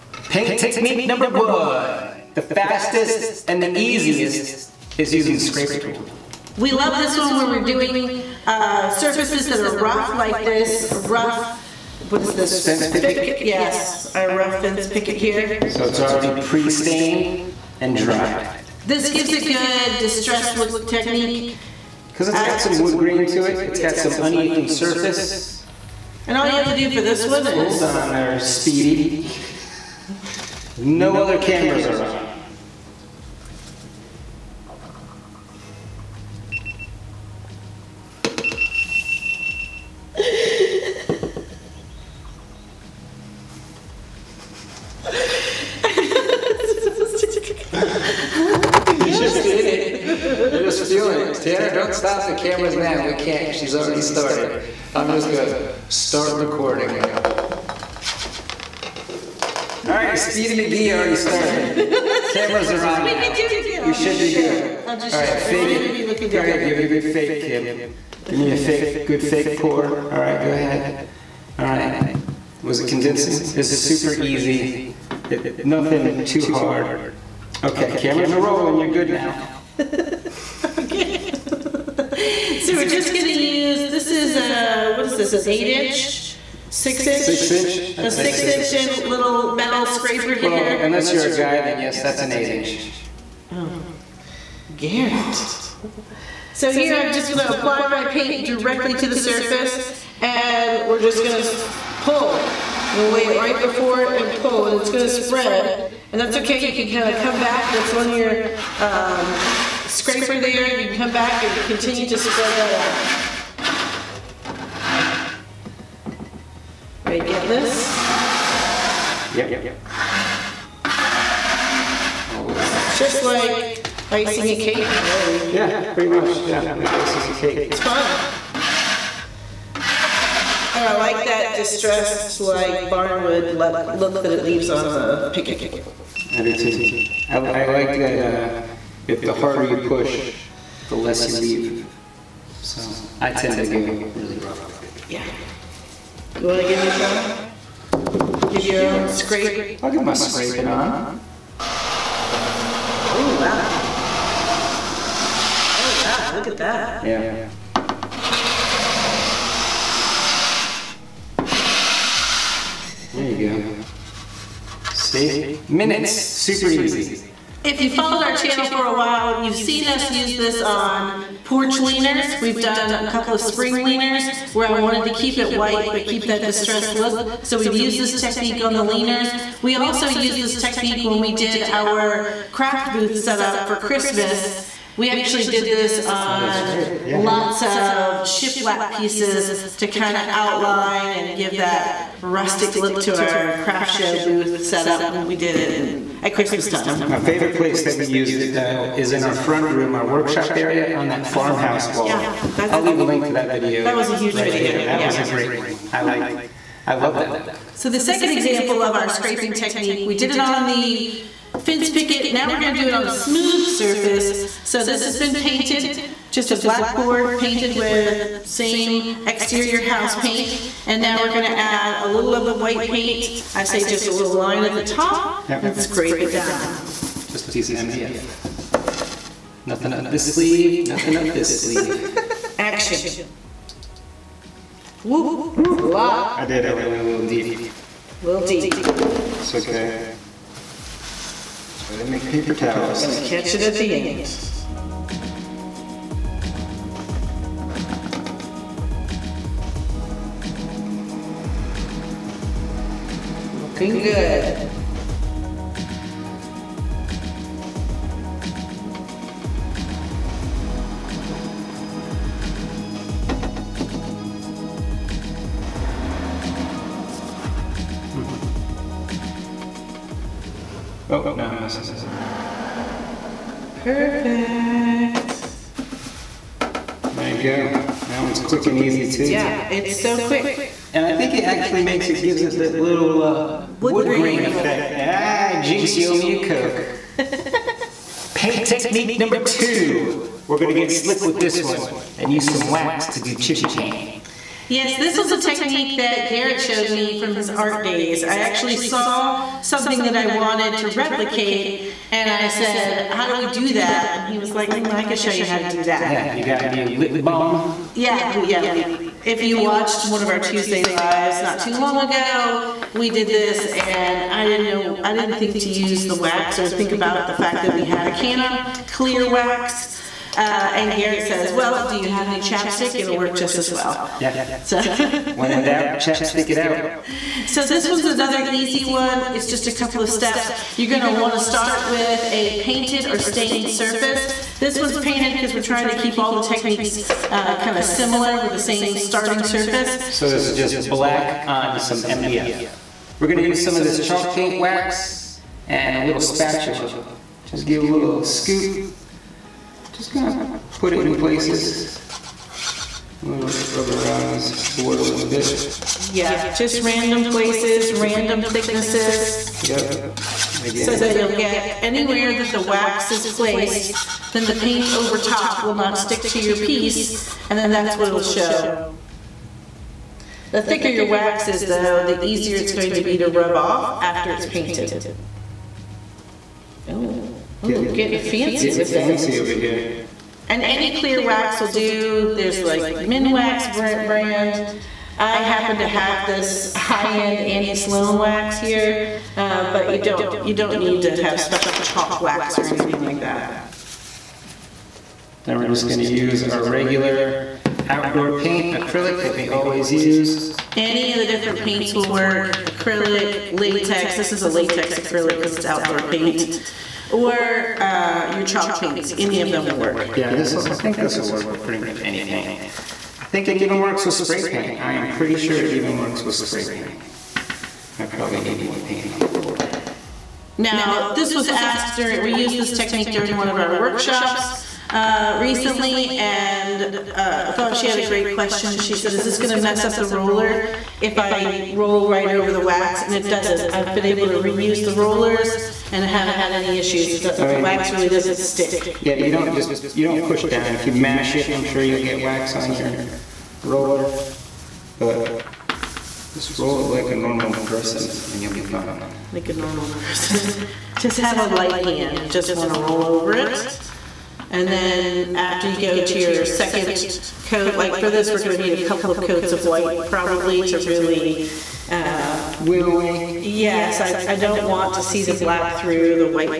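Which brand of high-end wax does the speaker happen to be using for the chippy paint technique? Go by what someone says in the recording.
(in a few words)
Annie Sloan.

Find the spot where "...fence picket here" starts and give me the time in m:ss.
0:14.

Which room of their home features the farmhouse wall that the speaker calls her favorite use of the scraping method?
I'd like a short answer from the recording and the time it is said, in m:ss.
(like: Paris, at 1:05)
Front room, at 3:19.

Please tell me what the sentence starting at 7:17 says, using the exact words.
the, the mean, wax really doesn't stick.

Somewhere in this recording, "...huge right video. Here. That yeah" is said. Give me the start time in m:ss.
3:24.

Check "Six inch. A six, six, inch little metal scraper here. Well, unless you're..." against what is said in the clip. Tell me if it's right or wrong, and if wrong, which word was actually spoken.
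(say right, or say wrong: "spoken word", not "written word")
right.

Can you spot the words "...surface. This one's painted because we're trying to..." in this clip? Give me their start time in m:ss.
5:33.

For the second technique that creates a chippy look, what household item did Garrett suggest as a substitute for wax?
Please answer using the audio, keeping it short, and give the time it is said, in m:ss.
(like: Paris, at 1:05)
Chapstick, at 5:22.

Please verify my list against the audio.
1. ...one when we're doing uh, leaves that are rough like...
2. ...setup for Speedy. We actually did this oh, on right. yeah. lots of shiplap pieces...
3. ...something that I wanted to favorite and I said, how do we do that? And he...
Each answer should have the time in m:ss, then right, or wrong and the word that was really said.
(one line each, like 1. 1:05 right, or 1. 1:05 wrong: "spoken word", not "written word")
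1. 0:07 wrong: "surfaces", not "leaves"
2. 3:03 wrong: "Christmas", not "Speedy"
3. 4:59 wrong: "replicate", not "favorite".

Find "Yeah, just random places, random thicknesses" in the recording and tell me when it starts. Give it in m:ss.
5:56.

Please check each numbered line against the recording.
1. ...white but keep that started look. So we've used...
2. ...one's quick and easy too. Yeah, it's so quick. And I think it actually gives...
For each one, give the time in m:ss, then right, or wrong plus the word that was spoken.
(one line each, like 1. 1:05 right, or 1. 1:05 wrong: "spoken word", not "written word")
1. 2:55 wrong: "distressed", not "started"
2. 4:38 wrong: "makes", not "gives".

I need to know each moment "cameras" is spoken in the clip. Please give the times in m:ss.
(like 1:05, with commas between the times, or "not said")
0:31, 0:52, 1:02, 1:17.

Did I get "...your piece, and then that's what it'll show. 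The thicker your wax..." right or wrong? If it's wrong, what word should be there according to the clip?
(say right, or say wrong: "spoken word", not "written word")
right.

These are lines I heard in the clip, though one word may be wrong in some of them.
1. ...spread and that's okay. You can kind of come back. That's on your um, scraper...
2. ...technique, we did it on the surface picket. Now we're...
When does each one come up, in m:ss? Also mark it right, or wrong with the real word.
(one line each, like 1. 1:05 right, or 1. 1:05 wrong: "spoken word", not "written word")
1. 1:45 right
2. 3:29 wrong: "fence", not "surface".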